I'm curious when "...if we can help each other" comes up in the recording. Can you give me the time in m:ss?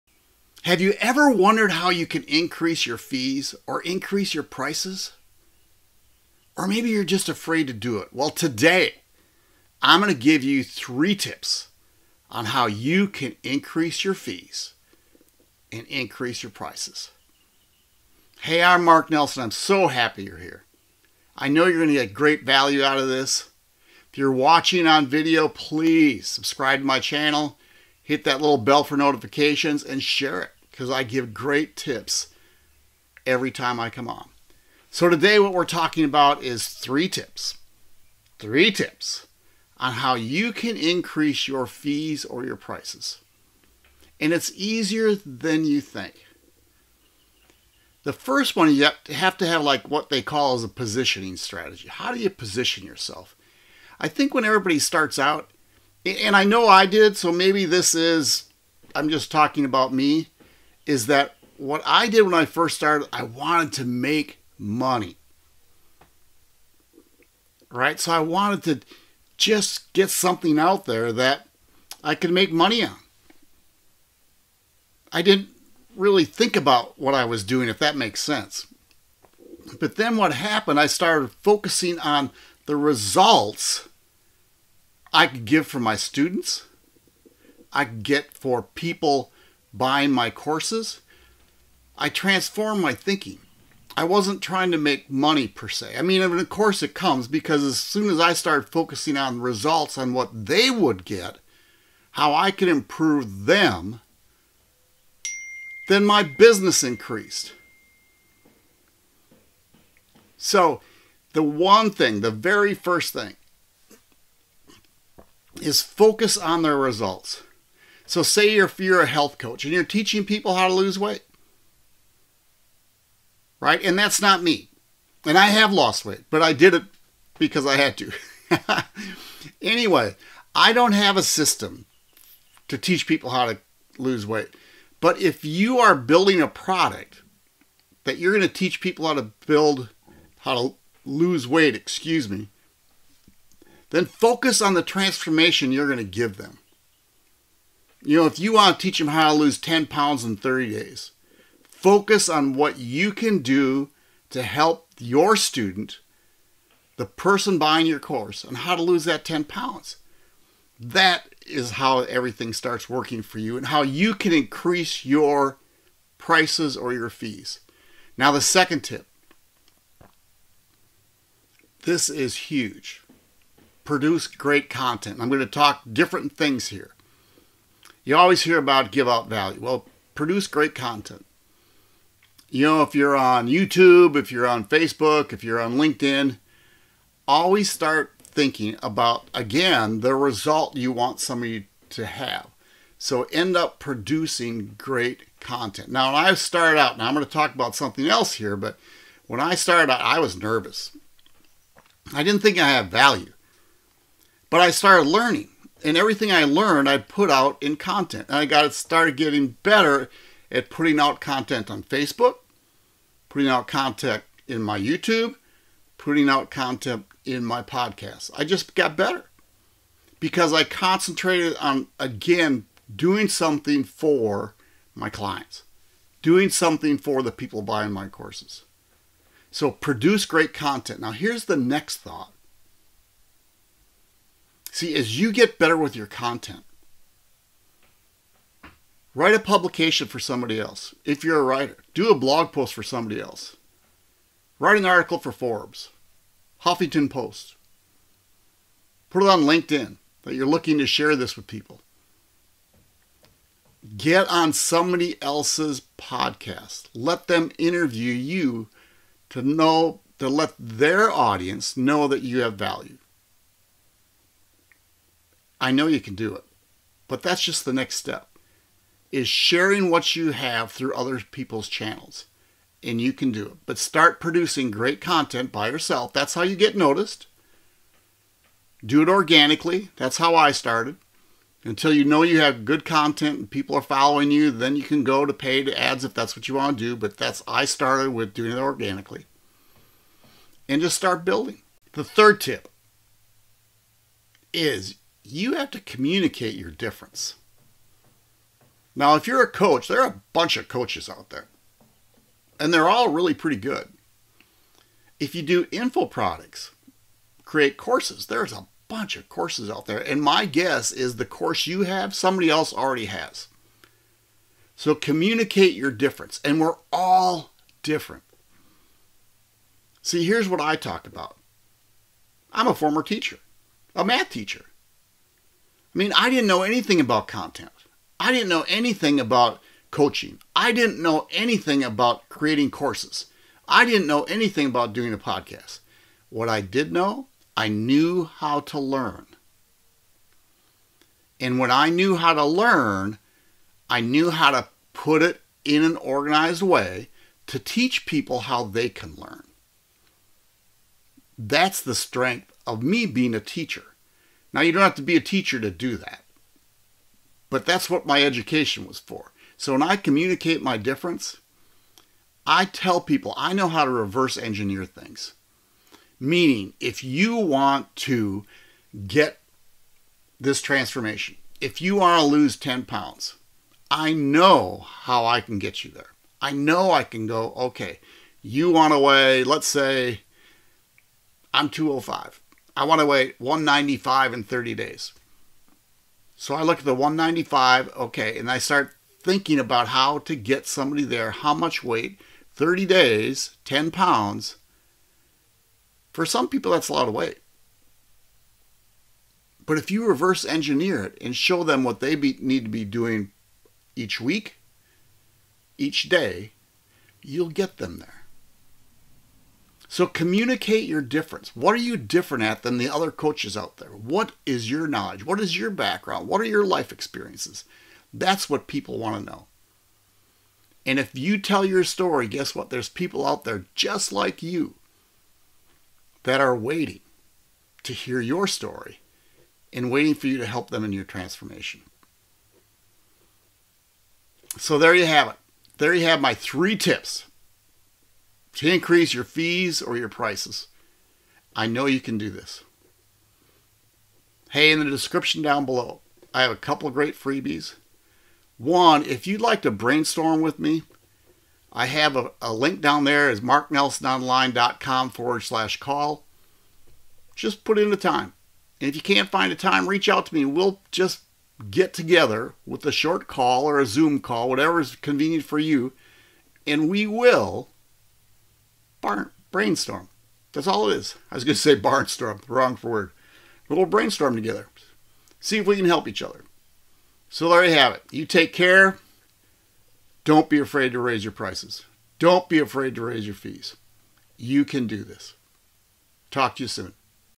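7:55.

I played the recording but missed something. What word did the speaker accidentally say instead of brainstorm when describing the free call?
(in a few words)
Barnstorm.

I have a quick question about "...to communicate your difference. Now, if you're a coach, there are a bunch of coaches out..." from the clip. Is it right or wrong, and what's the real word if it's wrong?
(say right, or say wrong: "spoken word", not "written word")
right.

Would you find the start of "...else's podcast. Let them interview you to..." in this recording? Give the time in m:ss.
4:15.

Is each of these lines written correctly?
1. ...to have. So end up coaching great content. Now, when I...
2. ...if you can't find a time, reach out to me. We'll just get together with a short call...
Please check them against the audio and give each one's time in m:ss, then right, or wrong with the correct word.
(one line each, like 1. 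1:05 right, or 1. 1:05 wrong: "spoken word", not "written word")
1. 3:11 wrong: "producing", not "coaching"
2. 7:38 right.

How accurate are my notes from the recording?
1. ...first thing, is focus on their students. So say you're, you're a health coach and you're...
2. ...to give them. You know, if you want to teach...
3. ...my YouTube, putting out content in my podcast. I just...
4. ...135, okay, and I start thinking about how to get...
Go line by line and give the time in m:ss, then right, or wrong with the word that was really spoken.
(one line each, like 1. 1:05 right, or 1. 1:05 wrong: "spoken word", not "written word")
1. 1:52 wrong: "results", not "students"
2. 2:25 right
3. 3:34 right
4. 6:26 wrong: "195", not "135".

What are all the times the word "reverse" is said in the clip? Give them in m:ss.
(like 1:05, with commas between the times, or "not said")
6:03, 6:40.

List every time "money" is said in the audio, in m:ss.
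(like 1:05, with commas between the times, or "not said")
1:04, 1:12, 1:35.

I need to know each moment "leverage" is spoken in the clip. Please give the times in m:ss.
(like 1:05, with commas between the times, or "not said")
not said.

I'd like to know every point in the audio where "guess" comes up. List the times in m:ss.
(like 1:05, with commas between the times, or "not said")
5:10, 7:02.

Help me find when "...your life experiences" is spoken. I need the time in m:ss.
6:56.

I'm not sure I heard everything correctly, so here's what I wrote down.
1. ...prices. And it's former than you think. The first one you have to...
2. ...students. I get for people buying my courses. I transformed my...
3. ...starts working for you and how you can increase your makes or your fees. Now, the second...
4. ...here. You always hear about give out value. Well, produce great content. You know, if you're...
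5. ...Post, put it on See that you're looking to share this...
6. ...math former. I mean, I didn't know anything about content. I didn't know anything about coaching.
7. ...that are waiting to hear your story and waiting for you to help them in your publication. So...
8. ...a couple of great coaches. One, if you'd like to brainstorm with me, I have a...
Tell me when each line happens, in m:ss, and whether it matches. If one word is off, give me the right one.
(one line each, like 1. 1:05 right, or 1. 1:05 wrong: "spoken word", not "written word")
1. 0:42 wrong: "easier", not "former"
2. 1:25 right
3. 2:42 wrong: "prices", not "makes"
4. 2:56 right
5. 4:07 wrong: "LinkedIn", not "See"
6. 5:24 wrong: "teacher", not "former"
7. 7:06 wrong: "transformation", not "publication"
8. 7:26 wrong: "freebies", not "coaches".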